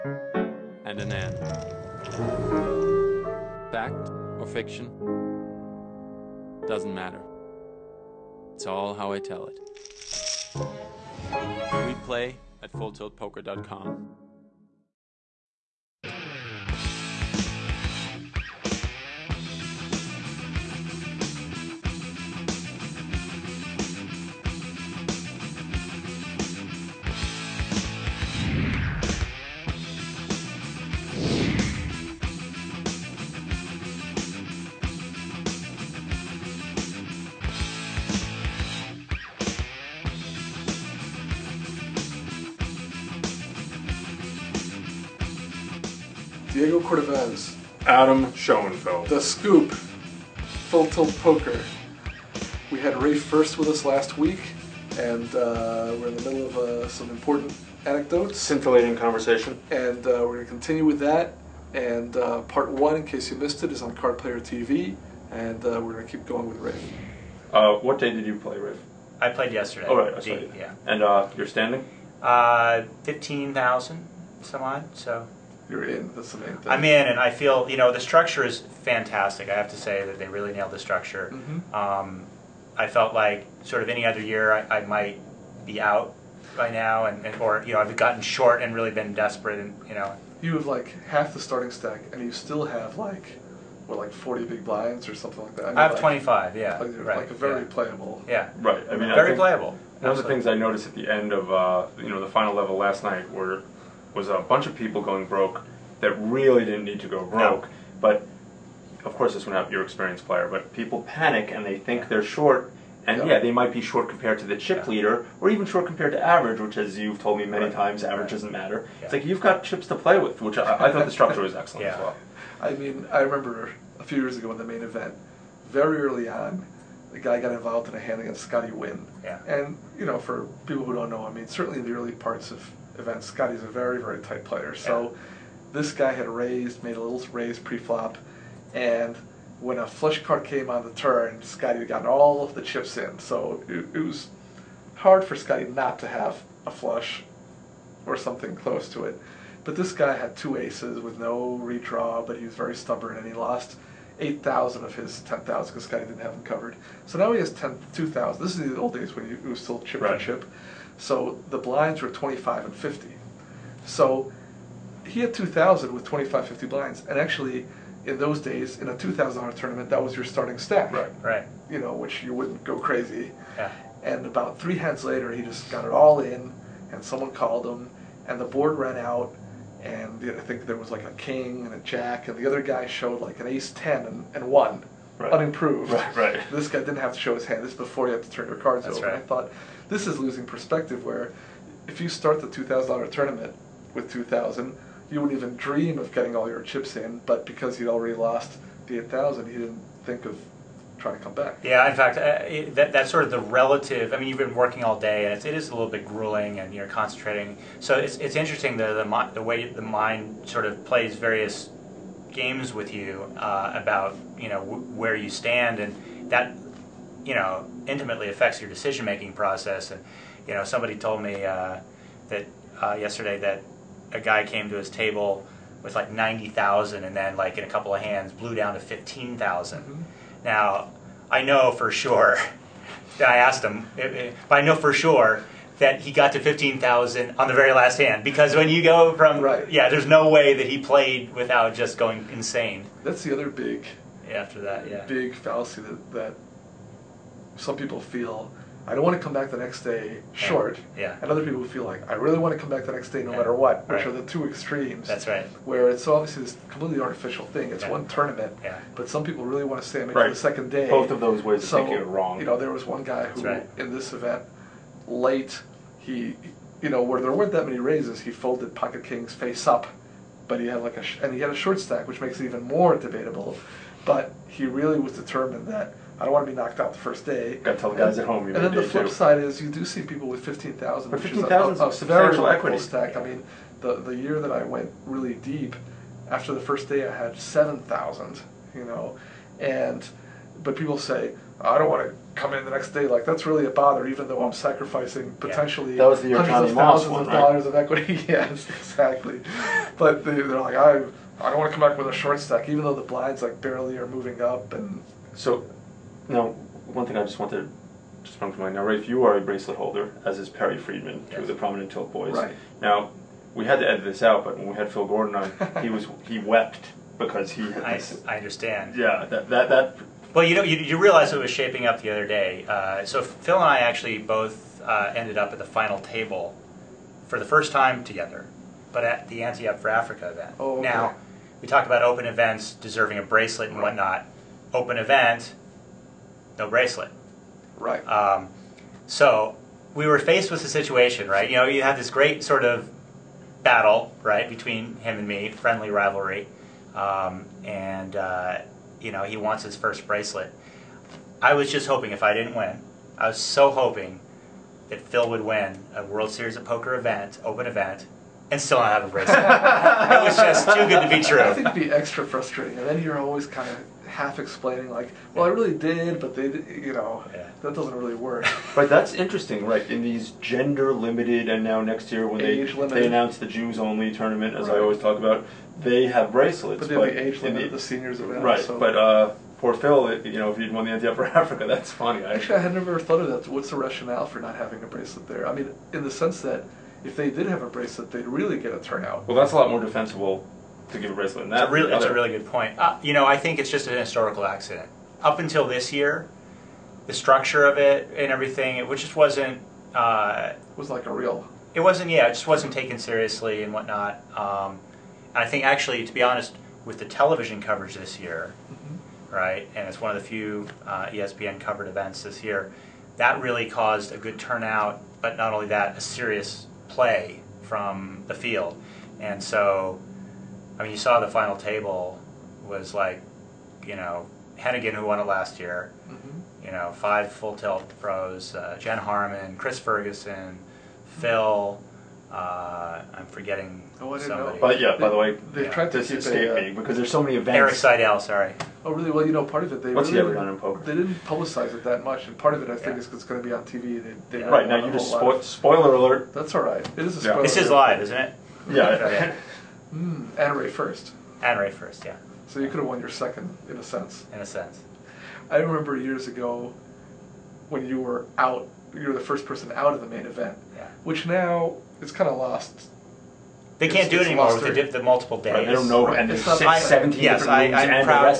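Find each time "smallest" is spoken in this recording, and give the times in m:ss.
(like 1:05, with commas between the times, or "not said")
not said.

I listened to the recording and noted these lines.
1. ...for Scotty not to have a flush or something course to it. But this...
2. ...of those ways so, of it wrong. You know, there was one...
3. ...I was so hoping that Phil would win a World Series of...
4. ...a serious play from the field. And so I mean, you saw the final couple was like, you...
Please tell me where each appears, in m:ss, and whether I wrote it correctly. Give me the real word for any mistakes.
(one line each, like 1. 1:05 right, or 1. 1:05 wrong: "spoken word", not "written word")
1. 2:25 wrong: "close", not "course"
2. 4:21 right
3. 5:53 right
4. 6:55 wrong: "table", not "couple".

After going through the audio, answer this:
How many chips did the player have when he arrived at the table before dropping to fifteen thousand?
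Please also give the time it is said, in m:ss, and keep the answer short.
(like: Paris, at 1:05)
90,000, at 3:46.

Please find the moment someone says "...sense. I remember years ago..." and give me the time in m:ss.
7:34.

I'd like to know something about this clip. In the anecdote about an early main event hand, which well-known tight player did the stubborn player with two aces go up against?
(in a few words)
Scotty Nguyen.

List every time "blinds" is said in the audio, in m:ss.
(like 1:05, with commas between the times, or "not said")
1:34, 2:41, 2:46, 5:03.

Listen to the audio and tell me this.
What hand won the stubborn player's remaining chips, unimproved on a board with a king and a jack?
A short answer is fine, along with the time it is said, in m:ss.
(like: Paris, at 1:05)
ace 10, at 3:03.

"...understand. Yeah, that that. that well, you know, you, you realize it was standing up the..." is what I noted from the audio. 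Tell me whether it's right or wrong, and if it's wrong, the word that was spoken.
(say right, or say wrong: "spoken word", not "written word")
wrong: "shaping", not "standing".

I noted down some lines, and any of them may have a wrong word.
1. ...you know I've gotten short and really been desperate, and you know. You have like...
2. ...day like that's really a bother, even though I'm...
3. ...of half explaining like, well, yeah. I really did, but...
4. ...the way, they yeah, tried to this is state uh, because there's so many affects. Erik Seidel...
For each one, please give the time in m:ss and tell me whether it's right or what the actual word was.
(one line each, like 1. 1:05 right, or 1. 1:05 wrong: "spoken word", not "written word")
1. 1:27 right
2. 4:52 right
3. 6:03 right
4. 7:15 wrong: "events", not "affects".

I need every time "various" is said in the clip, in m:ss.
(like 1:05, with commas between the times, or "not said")
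3:31.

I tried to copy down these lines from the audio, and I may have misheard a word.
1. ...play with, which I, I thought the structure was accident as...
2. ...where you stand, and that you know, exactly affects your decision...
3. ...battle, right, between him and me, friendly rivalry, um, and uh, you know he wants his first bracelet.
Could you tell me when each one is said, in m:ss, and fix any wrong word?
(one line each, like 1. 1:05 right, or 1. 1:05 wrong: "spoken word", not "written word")
1. 1:59 wrong: "excellent", not "accident"
2. 3:34 wrong: "intimately", not "exactly"
3. 5:43 right.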